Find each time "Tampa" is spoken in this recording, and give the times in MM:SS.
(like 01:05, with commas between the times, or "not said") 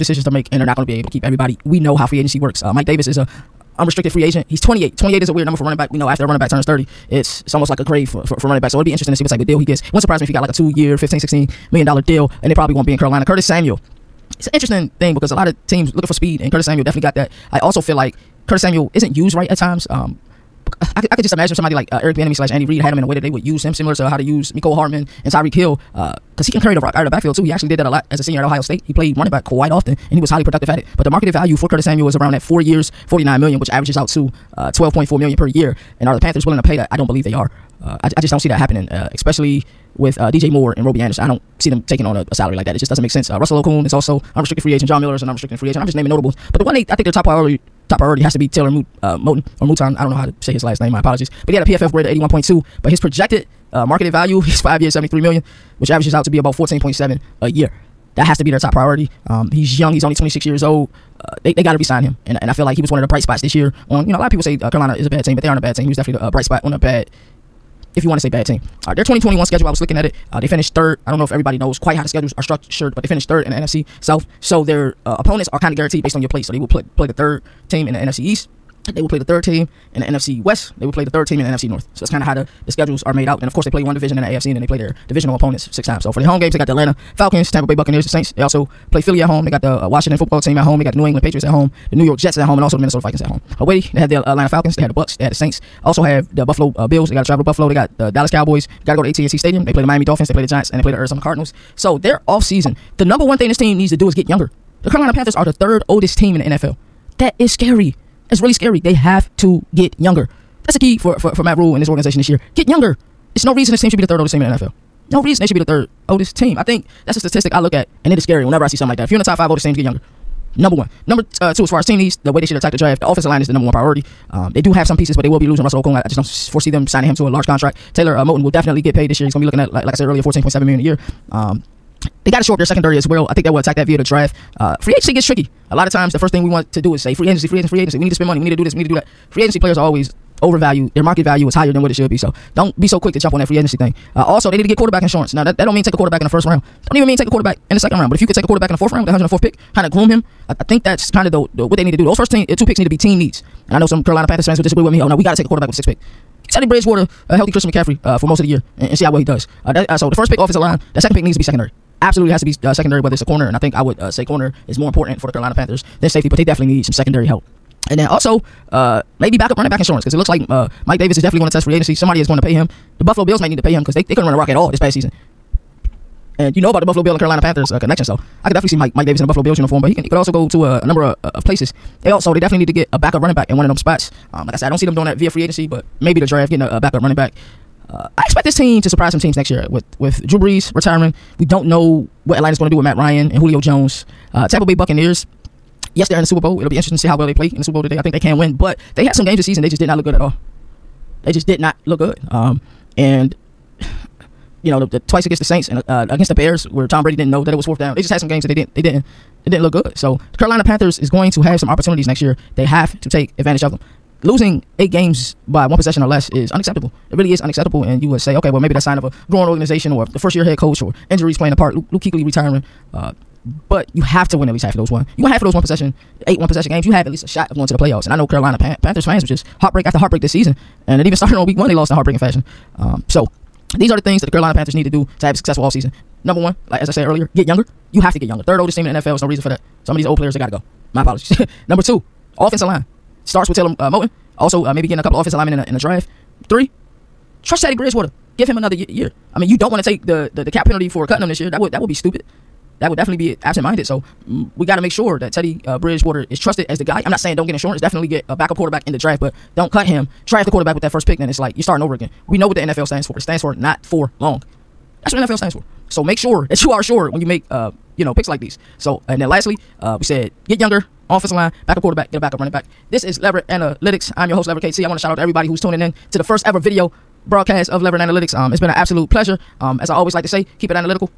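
01:27, 03:14.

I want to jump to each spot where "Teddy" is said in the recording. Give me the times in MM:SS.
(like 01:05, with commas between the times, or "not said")
02:36, 04:07, 04:15.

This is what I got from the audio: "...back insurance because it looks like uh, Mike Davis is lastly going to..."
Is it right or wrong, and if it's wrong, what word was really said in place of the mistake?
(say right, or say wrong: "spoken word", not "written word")
wrong: "definitely", not "lastly".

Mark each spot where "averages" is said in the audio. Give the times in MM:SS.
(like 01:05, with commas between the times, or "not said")
00:33, 00:55.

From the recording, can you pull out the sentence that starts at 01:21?
So that's kind of how the the schedules are made out.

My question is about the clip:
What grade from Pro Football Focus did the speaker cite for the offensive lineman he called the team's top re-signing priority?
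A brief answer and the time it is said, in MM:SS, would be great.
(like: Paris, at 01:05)
81.2, at 00:52.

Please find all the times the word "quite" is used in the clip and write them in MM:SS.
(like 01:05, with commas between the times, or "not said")
00:29, 01:11.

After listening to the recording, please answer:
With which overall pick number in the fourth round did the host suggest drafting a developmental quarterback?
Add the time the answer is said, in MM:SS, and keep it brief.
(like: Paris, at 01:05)
104th, at 02:29.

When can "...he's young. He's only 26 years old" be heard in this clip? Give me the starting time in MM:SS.
00:59.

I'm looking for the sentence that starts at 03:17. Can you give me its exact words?
I think they can win, but they had some games this season.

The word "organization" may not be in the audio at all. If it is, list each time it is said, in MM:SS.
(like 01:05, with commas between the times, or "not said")
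01:51, 03:39.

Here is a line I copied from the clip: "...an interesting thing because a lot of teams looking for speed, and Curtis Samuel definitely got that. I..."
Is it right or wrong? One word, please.
right.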